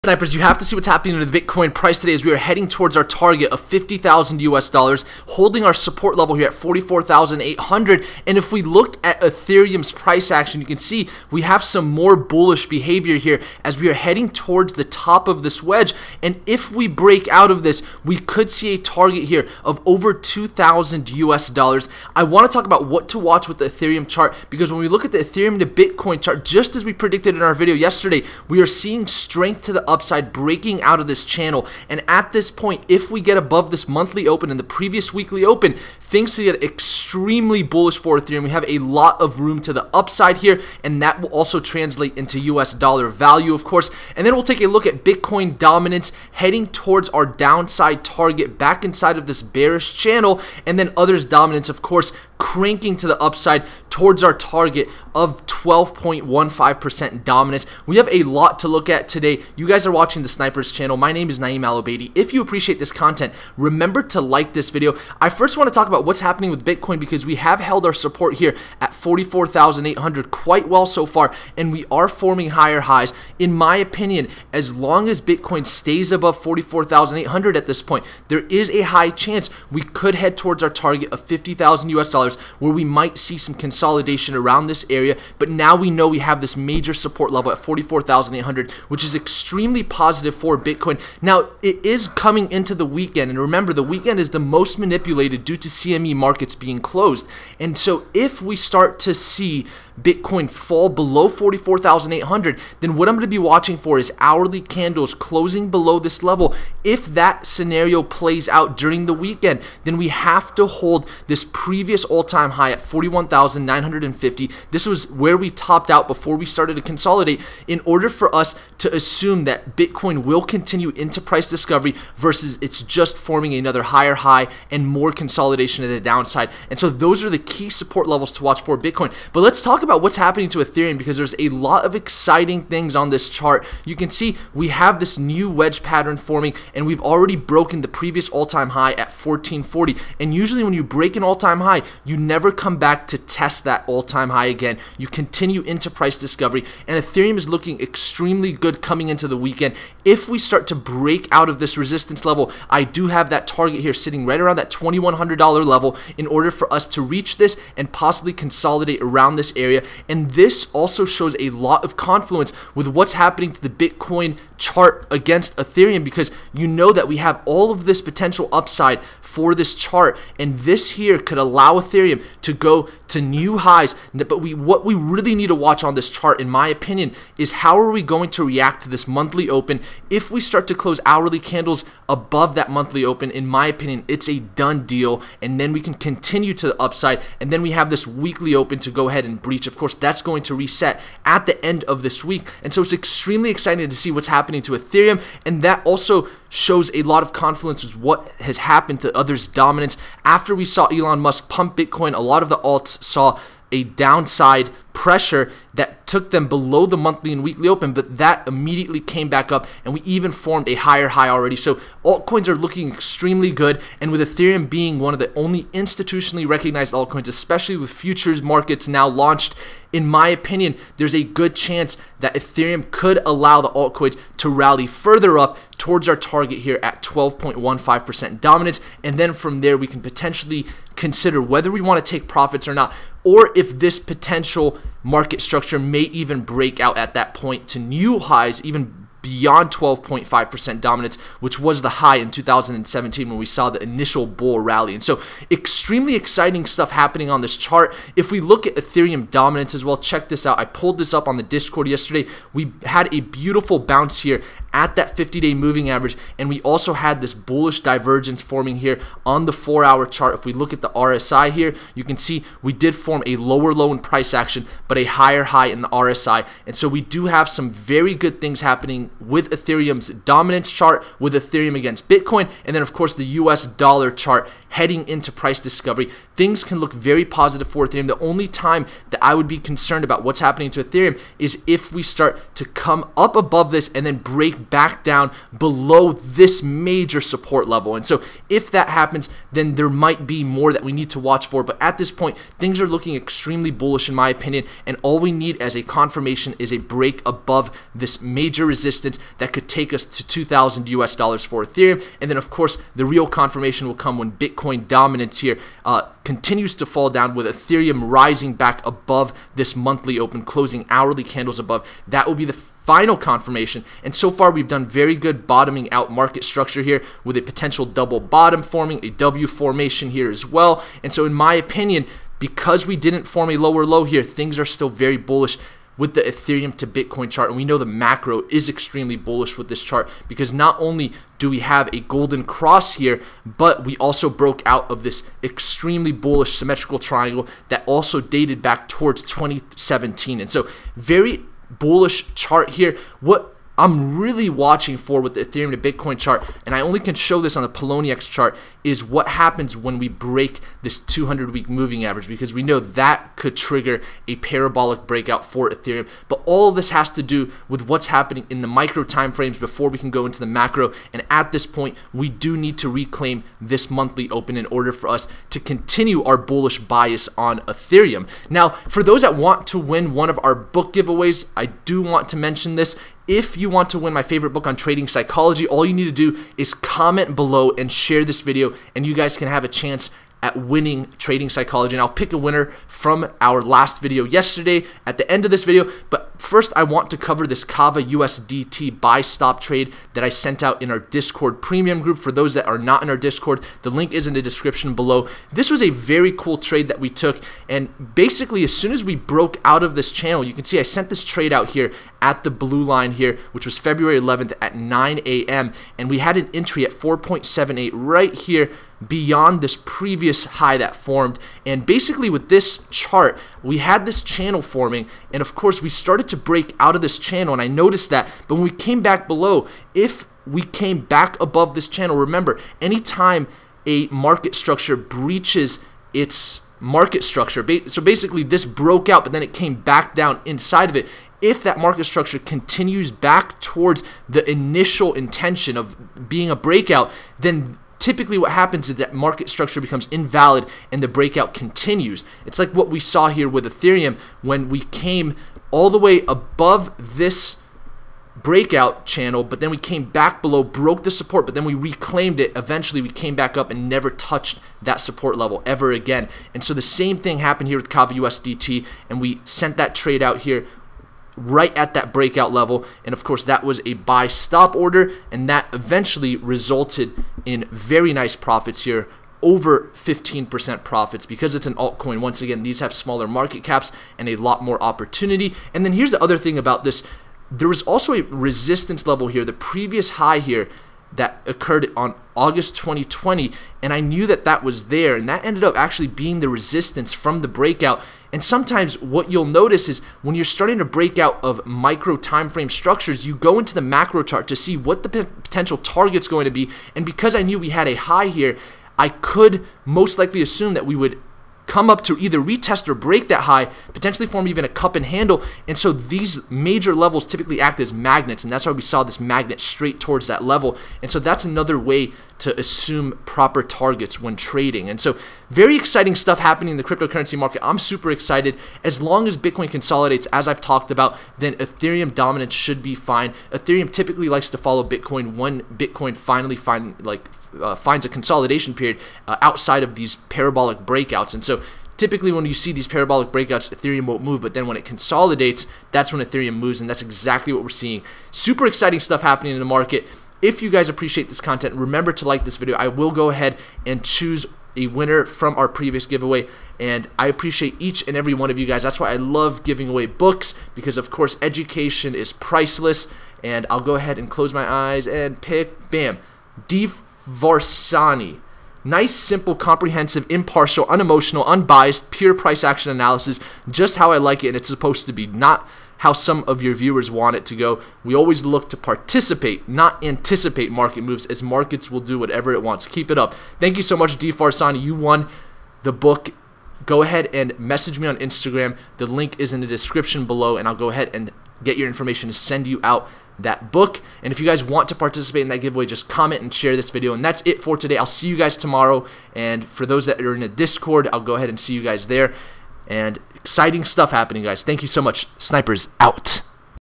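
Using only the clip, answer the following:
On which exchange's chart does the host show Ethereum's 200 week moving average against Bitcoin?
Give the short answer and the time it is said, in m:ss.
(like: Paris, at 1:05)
Poloniex, at 5:47.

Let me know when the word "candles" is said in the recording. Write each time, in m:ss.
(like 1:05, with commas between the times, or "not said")
1:44, 3:01, 5:11.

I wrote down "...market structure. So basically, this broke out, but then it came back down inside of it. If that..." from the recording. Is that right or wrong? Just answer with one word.
right.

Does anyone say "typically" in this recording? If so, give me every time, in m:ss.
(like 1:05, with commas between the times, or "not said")
7:18, 8:27, 8:43, 8:52.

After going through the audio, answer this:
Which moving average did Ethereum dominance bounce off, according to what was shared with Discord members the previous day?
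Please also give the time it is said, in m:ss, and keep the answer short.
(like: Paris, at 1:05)
50 day moving average, at 4:15.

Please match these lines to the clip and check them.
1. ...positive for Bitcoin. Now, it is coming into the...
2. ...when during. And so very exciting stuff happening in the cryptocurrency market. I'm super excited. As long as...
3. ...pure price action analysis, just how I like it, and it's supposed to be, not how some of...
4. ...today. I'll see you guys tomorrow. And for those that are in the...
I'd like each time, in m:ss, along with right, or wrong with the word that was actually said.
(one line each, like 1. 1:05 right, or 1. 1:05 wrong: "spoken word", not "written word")
1. 1:29 right
2. 8:34 wrong: "trading", not "during"
3. 9:22 right
4. 9:47 right.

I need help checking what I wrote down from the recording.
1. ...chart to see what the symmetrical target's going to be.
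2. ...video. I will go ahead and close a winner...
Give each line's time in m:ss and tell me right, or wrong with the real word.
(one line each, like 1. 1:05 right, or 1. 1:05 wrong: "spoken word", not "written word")
1. 8:14 wrong: "potential", not "symmetrical"
2. 9:02 wrong: "choose", not "close".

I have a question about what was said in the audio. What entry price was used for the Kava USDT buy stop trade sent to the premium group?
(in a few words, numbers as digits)
4.78.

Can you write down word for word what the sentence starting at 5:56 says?
But all this has to do with what's happening in the micro time frames before we can go into the macro.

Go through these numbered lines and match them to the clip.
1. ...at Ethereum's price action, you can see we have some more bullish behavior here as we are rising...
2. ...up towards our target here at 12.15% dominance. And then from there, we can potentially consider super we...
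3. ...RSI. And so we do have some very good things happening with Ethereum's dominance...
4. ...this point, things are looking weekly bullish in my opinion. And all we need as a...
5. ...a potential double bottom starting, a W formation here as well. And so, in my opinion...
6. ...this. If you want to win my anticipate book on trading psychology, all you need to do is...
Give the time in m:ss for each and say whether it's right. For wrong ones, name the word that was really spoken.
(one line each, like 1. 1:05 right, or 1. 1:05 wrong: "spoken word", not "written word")
1. 0:09 wrong: "heading", not "rising"
2. 3:45 wrong: "whether", not "super"
3. 4:25 right
4. 4:51 wrong: "extremely", not "weekly"
5. 5:17 wrong: "forming", not "starting"
6. 6:12 wrong: "favorite", not "anticipate".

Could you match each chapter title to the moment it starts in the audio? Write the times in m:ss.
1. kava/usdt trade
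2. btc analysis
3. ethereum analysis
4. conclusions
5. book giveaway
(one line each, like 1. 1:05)
1. 6:25
2. 1:05
3. 2:10
4. 8:50
5. 6:10.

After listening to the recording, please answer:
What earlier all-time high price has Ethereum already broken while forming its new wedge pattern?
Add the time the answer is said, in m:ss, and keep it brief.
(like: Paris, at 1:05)
1440, at 2:19.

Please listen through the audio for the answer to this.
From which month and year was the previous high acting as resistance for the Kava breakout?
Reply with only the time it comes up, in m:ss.
8:02.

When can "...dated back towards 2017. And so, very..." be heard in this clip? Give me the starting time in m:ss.
5:38.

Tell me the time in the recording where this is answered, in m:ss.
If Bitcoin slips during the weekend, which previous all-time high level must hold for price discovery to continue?
1:52.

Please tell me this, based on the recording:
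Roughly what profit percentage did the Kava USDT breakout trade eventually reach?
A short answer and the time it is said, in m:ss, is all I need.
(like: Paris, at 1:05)
over 15%, at 7:49.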